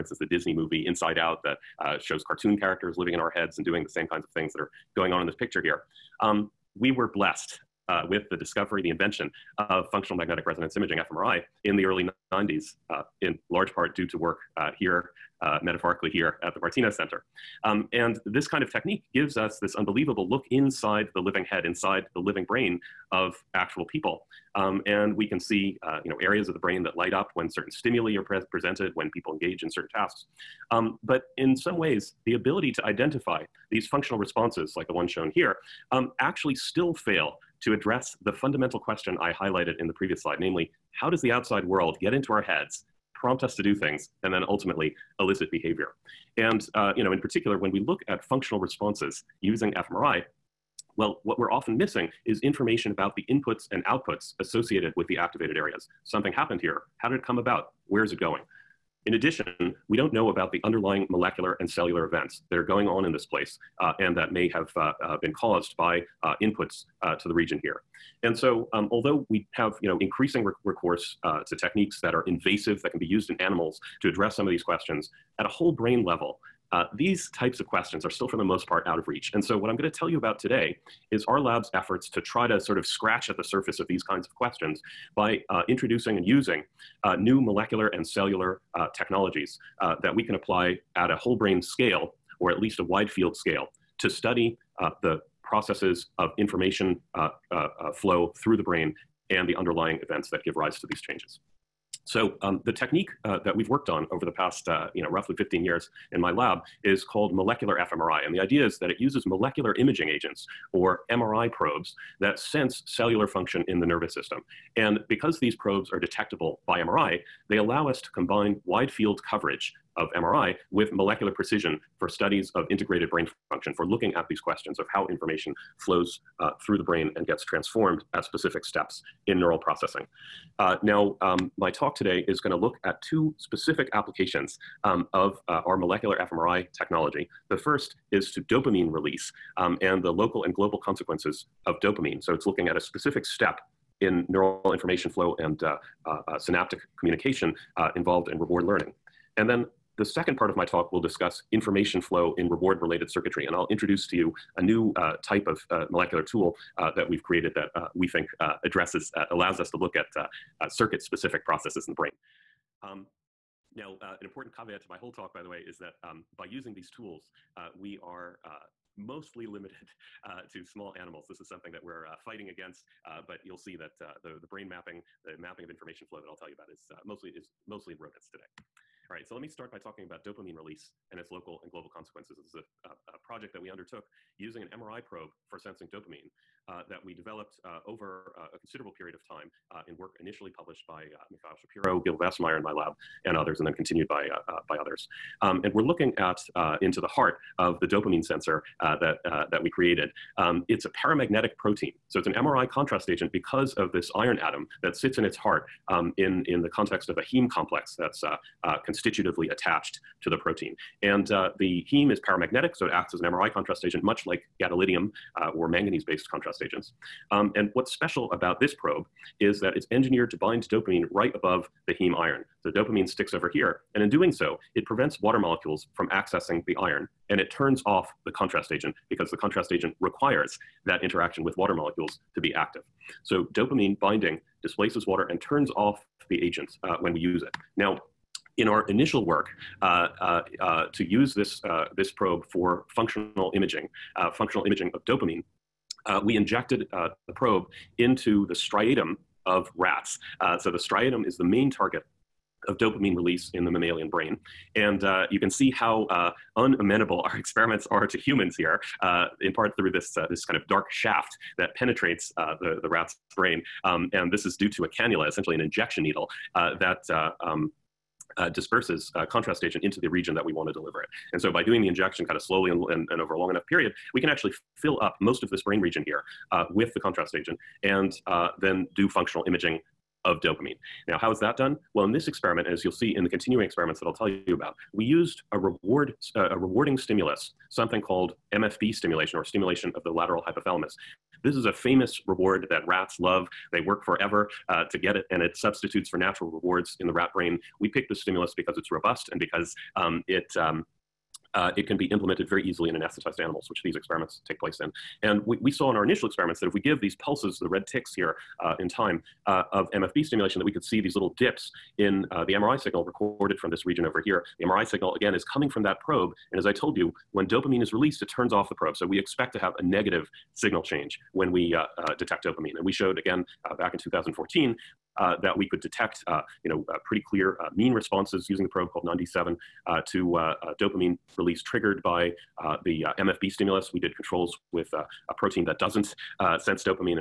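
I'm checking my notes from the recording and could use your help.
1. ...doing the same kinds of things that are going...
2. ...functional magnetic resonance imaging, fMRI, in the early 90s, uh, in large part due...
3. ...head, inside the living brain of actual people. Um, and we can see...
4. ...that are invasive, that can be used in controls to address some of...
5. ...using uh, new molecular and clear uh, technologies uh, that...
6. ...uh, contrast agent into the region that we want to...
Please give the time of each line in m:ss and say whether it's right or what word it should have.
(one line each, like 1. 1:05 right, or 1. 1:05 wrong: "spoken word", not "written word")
1. 0:03 right
2. 0:09 right
3. 0:21 right
4. 1:12 wrong: "animals", not "controls"
5. 1:26 wrong: "cellular", not "clear"
6. 4:29 right.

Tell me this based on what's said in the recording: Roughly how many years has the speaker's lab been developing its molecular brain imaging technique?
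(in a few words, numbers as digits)
15 years.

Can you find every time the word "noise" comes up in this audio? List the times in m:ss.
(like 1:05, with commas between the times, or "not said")
not said.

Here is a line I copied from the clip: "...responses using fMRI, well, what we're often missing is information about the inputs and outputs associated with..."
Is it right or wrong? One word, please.
right.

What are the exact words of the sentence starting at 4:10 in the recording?
so the striatum is the main target of dopamine release in the mammalian brain.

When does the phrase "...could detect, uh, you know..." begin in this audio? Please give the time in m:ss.
5:25.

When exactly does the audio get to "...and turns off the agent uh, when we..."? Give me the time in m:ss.
3:55.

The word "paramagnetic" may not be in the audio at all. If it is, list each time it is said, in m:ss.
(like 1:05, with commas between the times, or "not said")
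3:21, 3:32.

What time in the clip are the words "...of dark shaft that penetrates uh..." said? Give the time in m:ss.
4:20.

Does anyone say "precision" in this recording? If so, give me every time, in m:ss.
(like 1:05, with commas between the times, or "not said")
2:01.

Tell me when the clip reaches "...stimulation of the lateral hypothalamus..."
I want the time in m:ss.
4:49.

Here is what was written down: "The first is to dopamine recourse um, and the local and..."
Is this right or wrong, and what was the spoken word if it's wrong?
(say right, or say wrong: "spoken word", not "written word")
wrong: "release", not "recourse".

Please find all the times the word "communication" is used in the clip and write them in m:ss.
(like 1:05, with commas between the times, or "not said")
2:26.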